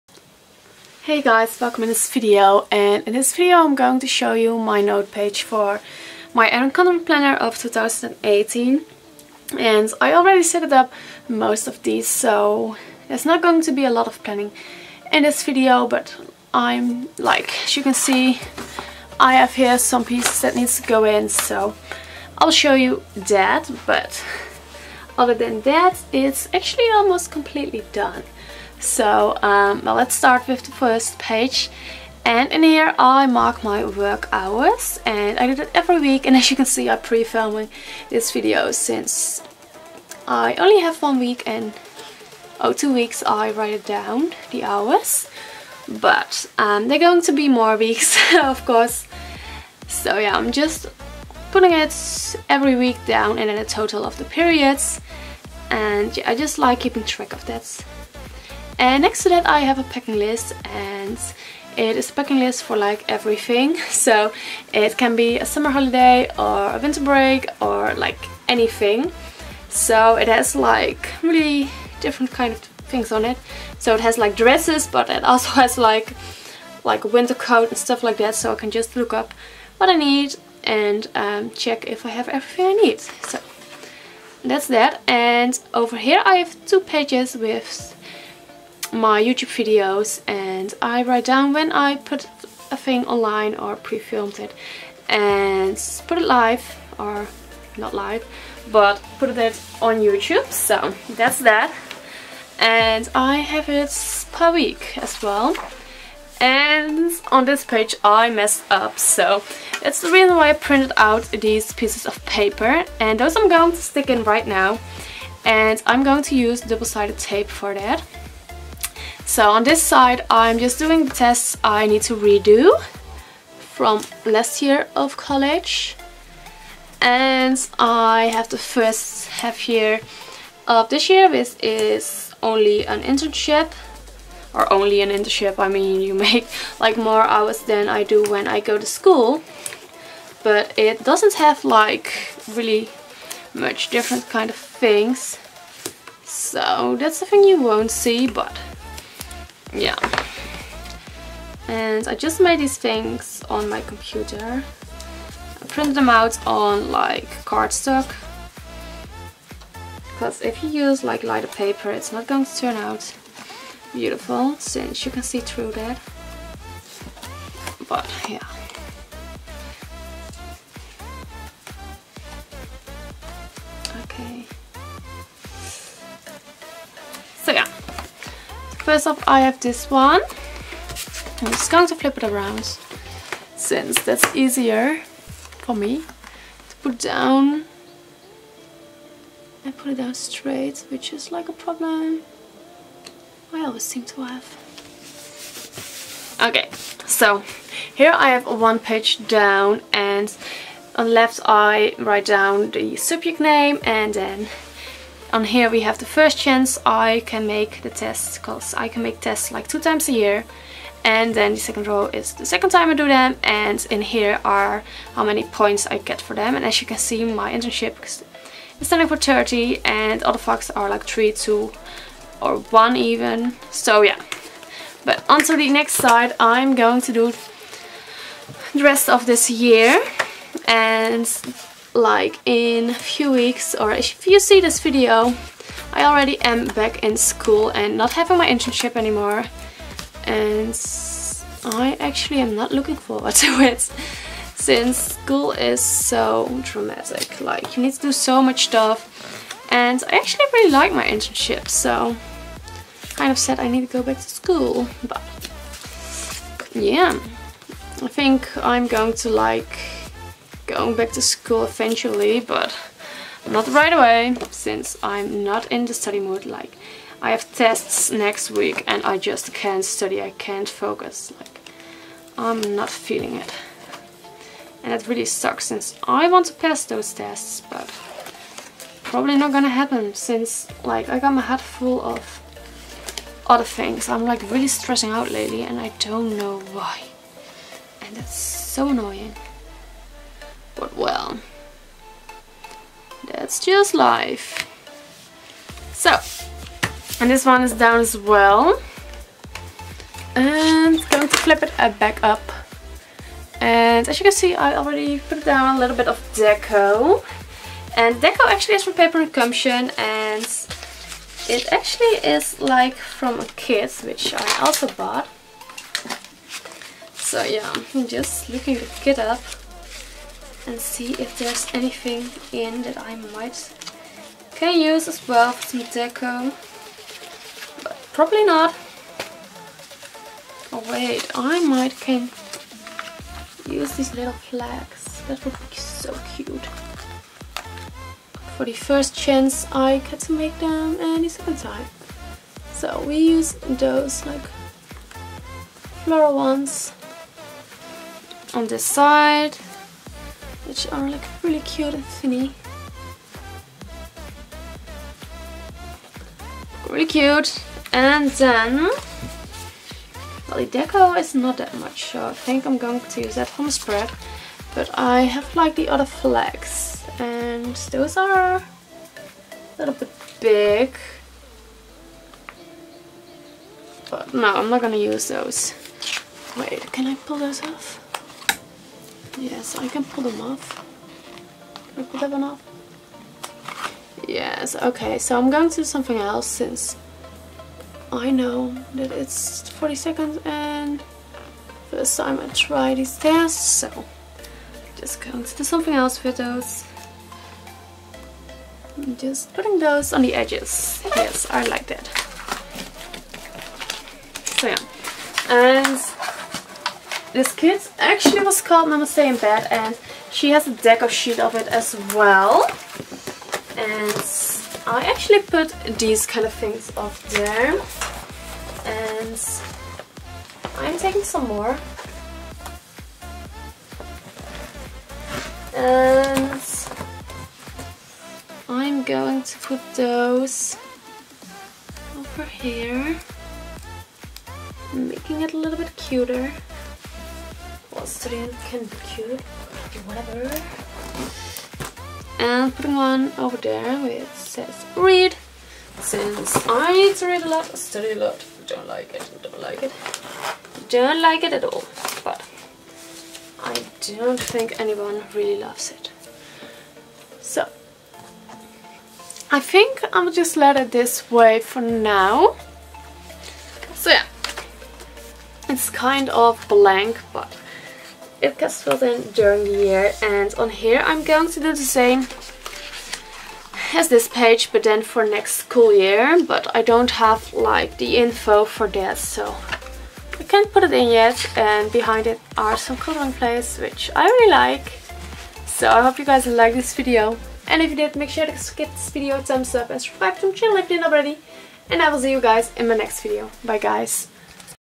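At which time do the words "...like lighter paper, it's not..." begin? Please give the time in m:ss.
2:41.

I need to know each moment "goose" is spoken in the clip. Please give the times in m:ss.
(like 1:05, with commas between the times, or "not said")
not said.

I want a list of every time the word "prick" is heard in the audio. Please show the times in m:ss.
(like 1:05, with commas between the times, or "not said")
not said.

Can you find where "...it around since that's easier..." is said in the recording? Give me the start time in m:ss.
3:02.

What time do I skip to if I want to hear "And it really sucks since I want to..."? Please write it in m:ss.
4:34.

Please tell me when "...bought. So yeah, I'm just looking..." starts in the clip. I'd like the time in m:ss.
5:14.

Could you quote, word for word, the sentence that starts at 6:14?
But no, I'm not gonna use those.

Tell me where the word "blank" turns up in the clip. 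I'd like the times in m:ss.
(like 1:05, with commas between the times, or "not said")
7:46.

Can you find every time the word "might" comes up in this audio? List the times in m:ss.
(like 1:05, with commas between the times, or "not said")
5:23, 5:31.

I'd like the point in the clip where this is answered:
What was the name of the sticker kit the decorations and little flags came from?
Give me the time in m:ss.
6:48.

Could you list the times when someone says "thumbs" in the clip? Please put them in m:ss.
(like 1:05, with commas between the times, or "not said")
8:09.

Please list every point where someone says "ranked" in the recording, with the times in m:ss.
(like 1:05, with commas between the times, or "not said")
not said.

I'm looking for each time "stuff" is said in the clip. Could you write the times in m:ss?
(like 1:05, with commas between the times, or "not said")
1:17, 4:08.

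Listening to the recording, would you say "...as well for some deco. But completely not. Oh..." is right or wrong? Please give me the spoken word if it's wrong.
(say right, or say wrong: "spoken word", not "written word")
wrong: "probably", not "completely".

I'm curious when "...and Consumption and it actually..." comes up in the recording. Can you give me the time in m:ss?
5:09.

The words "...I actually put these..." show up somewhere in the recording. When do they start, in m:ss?
6:54.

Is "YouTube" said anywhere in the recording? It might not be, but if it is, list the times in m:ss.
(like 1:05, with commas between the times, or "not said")
1:29, 1:40.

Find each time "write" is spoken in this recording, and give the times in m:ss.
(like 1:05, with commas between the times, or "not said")
0:43, 1:31, 3:21.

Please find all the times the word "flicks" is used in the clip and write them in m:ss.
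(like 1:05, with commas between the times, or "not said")
not said.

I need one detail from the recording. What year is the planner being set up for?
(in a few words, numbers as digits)
2018.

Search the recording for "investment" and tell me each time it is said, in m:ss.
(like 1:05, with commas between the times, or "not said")
not said.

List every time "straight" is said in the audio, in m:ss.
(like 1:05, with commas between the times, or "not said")
3:10.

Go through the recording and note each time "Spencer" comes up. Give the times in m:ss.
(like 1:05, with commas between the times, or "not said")
not said.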